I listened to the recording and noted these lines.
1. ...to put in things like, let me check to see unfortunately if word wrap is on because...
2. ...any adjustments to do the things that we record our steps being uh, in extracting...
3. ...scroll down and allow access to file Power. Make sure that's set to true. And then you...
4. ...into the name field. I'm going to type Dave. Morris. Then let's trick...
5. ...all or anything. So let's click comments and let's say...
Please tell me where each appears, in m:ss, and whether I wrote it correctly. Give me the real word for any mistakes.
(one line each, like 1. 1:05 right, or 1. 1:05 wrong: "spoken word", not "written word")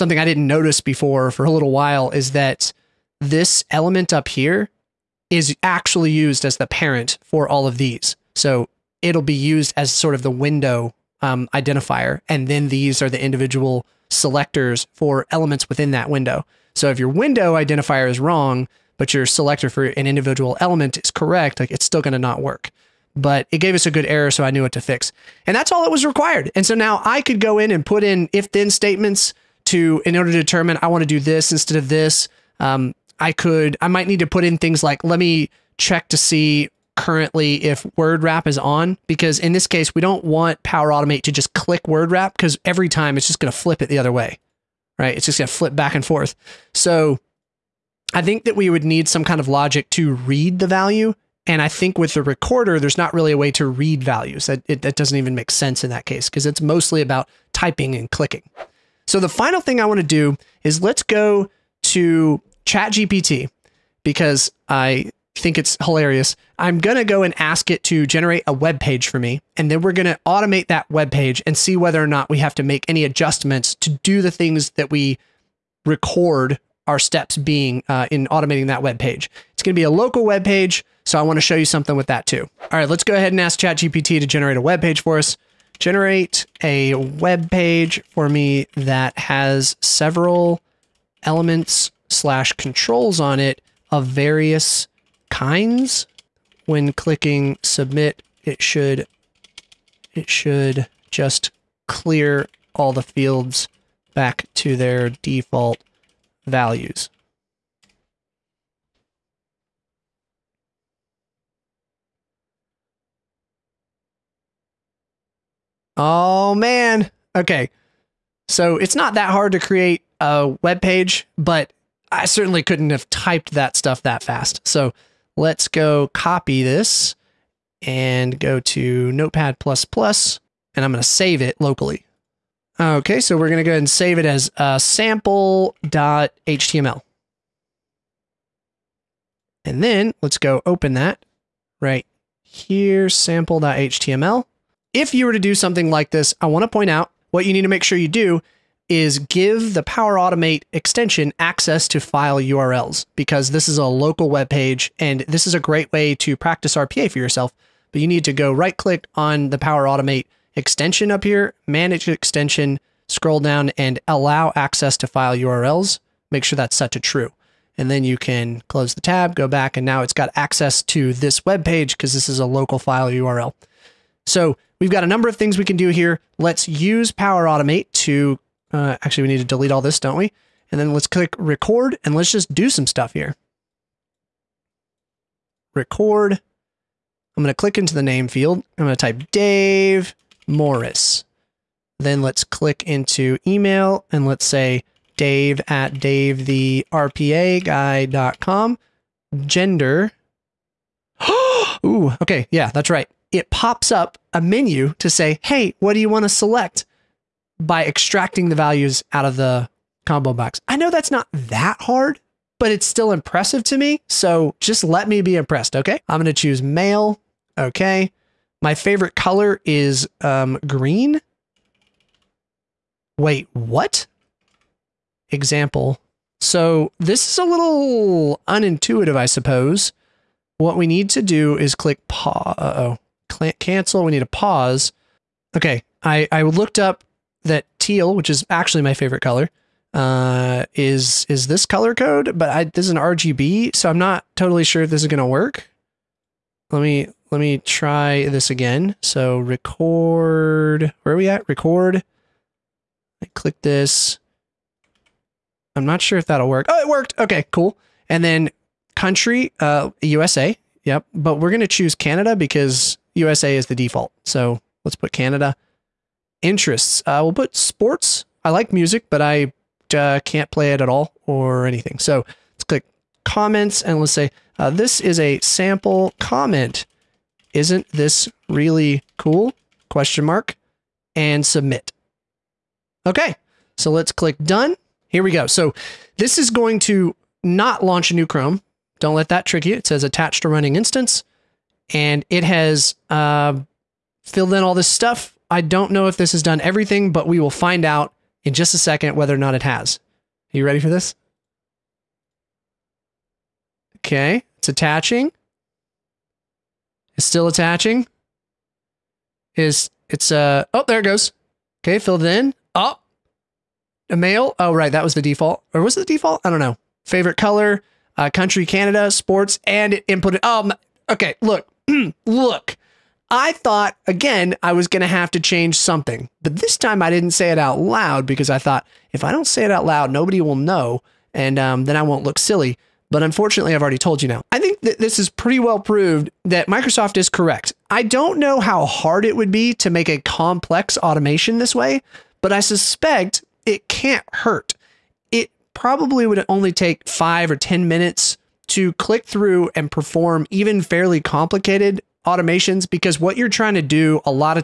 1. 0:34 wrong: "currently", not "unfortunately"
2. 1:12 wrong: "automating", not "extracting"
3. 2:43 wrong: "URLs", not "Power"
4. 3:07 wrong: "click", not "trick"
5. 4:30 right.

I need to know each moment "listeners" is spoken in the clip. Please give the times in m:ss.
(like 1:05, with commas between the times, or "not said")
not said.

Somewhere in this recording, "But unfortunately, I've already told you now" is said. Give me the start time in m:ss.
5:33.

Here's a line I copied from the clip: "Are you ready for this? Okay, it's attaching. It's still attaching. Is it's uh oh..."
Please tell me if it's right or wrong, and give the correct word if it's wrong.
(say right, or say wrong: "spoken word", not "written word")
right.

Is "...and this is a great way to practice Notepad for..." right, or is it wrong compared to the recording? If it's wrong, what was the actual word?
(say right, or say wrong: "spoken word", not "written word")
wrong: "RPA", not "Notepad".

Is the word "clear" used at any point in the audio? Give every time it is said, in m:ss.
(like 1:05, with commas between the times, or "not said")
1:41.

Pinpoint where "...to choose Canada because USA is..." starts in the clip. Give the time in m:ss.
4:21.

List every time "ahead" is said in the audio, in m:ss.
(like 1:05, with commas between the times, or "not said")
1:23, 2:13.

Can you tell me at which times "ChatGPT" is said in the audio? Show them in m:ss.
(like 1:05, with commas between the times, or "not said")
1:02, 1:23.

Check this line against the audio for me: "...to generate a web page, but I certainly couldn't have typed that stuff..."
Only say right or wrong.
wrong.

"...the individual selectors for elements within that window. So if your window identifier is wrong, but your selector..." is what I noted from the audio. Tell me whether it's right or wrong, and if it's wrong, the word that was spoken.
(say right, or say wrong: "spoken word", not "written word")
right.